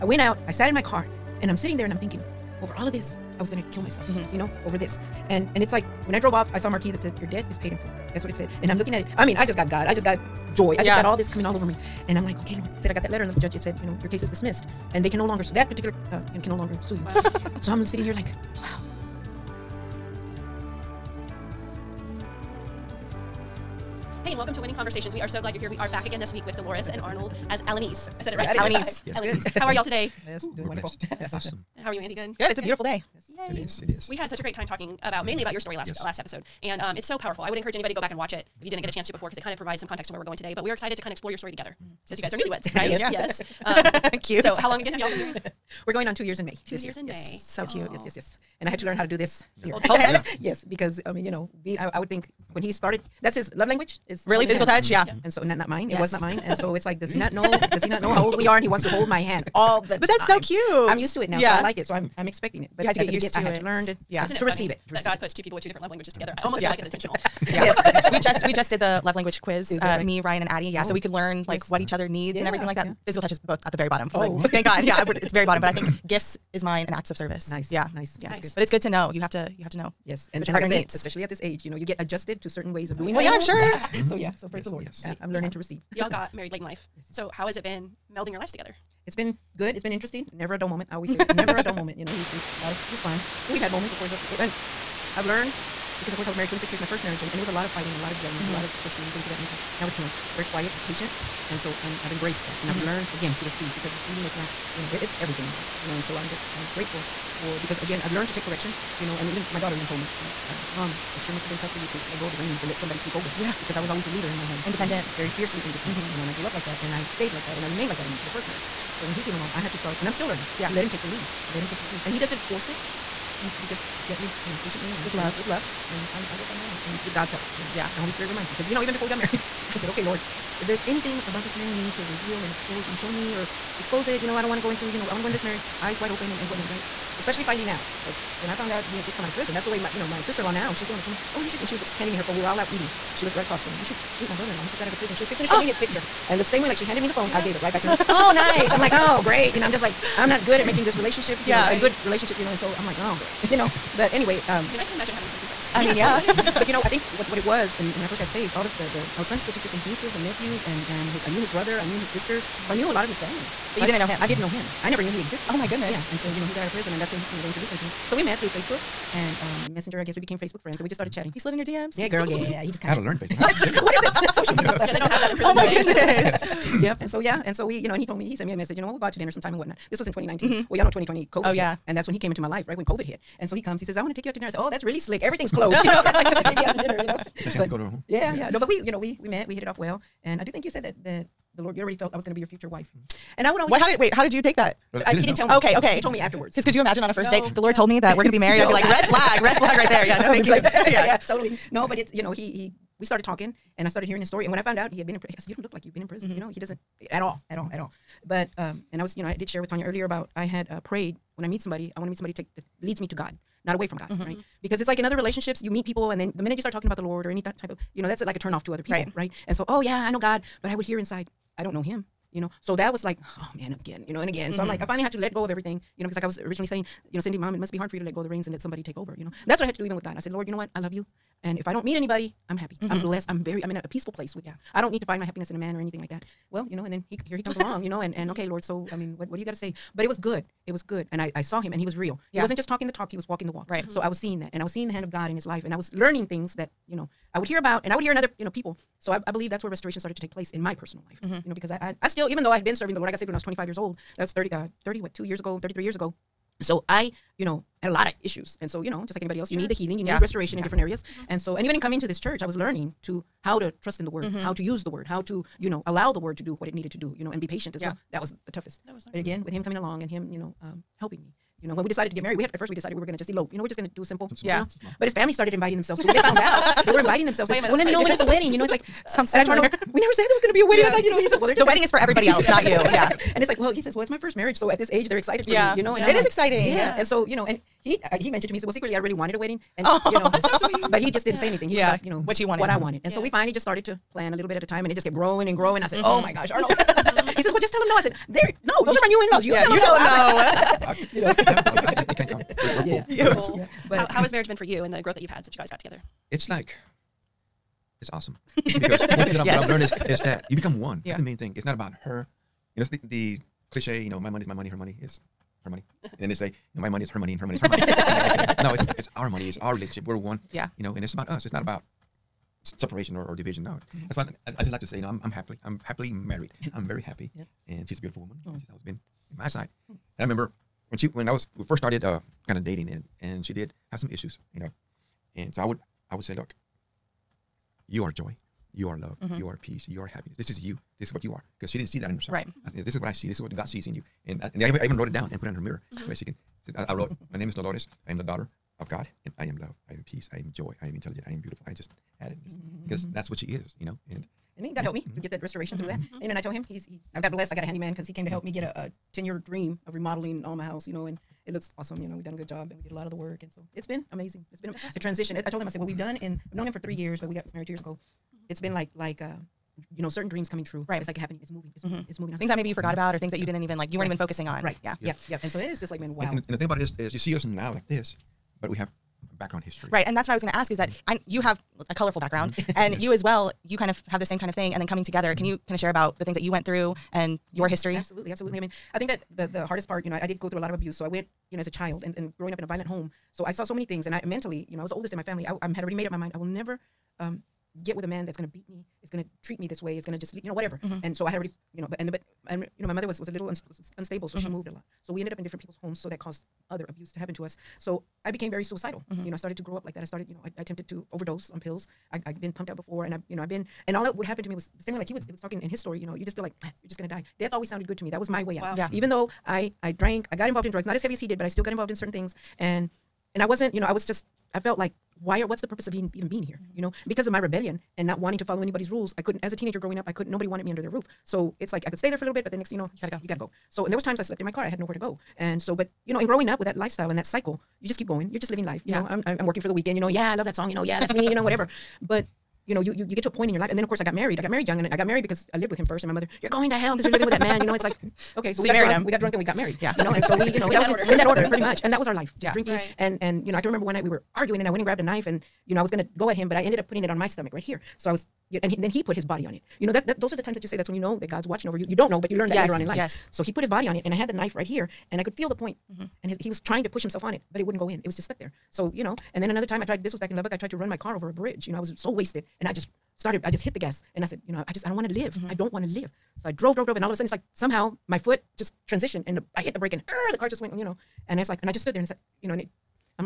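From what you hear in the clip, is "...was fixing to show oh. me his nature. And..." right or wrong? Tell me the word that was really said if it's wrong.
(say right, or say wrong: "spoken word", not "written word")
wrong: "picture", not "nature".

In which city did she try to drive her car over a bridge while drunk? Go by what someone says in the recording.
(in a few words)
Lubbock.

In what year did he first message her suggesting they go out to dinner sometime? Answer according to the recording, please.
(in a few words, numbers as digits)
2019.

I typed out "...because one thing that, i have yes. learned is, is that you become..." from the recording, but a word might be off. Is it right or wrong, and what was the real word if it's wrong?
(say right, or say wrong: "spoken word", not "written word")
right.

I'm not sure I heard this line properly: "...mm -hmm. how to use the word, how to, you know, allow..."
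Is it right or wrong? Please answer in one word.
right.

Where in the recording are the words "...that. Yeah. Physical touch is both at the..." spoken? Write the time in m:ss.
1:12.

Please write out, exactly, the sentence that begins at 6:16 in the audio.
And, and, and, the thing about it is, is you see us now like this, but we have background history.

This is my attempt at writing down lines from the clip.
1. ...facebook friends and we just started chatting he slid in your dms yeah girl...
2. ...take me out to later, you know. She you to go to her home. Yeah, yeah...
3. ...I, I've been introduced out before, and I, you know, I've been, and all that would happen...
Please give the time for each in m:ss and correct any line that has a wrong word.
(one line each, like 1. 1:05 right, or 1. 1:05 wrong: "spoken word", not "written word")
1. 2:50 right
2. 3:06 wrong: "dinner", not "later"
3. 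6:52 wrong: "pumped", not "introduced".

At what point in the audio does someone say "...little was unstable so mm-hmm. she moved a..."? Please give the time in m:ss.
6:43.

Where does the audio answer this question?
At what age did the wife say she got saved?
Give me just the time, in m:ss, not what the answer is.
4:13.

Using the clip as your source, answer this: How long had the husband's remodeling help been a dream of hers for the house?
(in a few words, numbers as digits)
10 years.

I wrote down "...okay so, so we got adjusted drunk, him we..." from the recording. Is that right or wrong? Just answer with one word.
wrong.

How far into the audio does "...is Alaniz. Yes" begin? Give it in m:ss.
0:28.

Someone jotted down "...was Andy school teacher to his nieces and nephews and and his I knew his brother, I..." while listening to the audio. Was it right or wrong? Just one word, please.
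wrong.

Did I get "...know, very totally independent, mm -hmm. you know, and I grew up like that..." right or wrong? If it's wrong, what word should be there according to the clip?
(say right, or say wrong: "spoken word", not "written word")
wrong: "fiercely", not "totally".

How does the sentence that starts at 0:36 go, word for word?
last episode, and um, it's so powerful.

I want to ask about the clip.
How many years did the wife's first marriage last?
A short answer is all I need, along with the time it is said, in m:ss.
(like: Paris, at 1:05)
26 years, at 1:36.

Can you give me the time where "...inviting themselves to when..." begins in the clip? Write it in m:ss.
4:35.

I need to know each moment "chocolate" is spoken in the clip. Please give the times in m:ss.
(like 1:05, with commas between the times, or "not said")
not said.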